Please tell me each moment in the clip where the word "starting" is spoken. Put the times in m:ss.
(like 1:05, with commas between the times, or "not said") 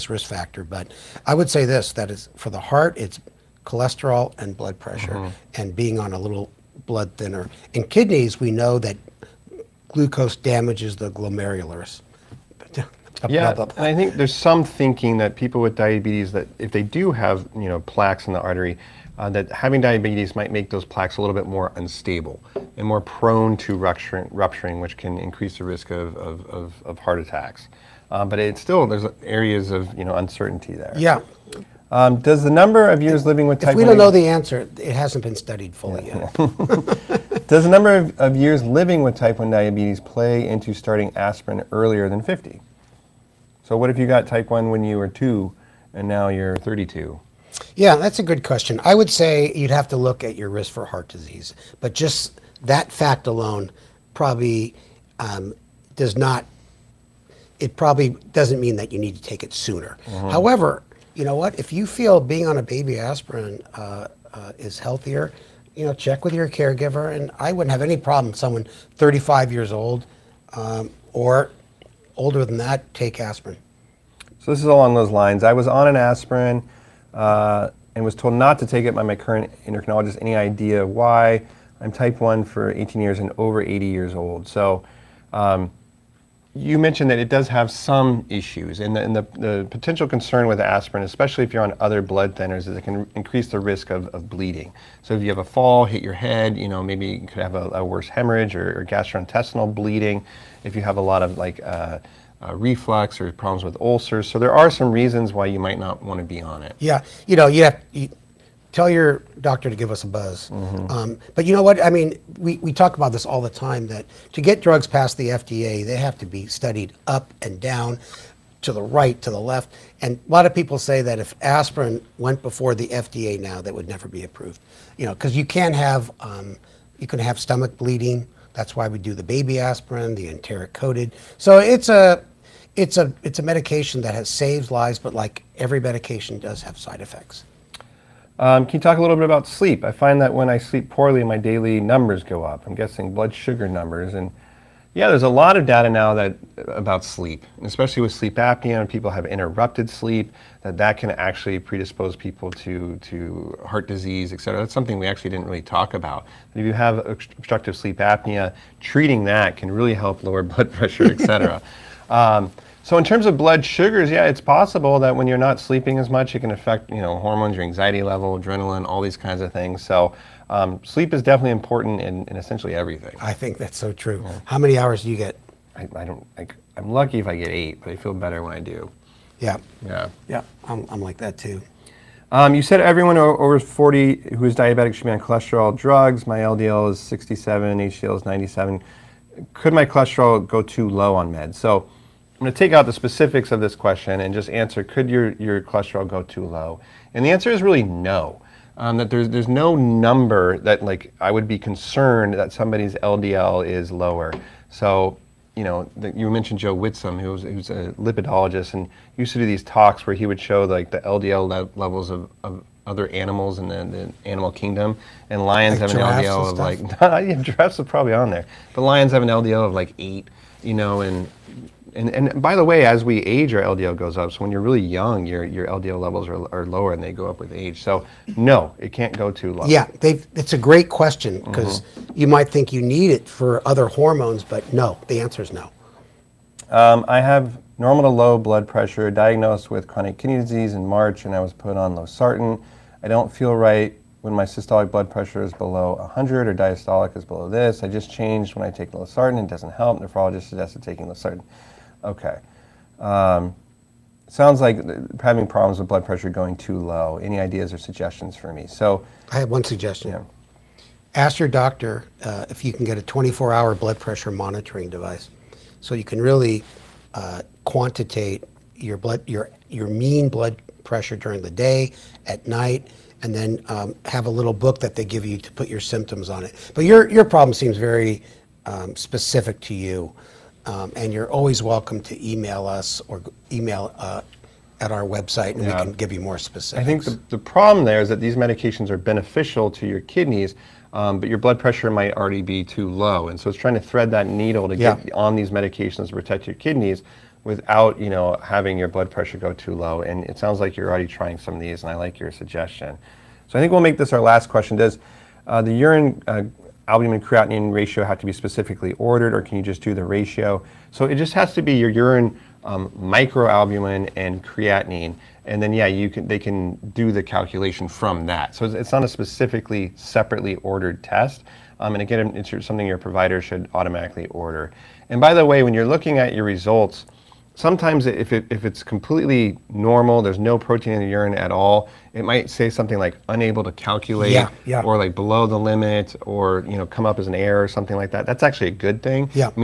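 0:40.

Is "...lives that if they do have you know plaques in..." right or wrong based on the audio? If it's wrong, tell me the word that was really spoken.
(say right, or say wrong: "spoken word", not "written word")
wrong: "diabetes", not "lives".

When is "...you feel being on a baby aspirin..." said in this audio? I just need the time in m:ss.
1:01.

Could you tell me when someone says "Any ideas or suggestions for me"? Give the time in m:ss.
4:17.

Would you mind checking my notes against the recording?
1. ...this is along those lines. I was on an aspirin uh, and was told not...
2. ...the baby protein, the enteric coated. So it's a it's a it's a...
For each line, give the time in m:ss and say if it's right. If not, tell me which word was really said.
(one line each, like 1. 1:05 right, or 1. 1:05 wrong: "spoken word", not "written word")
1. 1:14 right
2. 2:09 wrong: "aspirin", not "protein".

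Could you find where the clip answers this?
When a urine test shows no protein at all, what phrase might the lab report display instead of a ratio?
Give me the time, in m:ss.
5:33.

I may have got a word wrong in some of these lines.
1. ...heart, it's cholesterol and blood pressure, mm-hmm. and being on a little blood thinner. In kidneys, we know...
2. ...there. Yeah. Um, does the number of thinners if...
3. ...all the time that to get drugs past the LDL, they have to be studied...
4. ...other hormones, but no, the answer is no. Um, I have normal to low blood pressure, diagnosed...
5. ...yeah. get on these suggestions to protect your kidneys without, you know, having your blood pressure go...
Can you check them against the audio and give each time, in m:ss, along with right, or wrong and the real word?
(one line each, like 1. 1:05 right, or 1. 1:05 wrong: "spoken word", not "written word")
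1. 0:02 right
2. 0:30 wrong: "years", not "thinners"
3. 1:53 wrong: "FDA", not "LDL"
4. 3:53 right
5. 4:54 wrong: "medications", not "suggestions".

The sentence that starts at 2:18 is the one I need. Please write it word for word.
Um, can you talk a little bit about sleep?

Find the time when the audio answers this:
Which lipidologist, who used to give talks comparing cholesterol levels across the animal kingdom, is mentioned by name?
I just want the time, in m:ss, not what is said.
3:26.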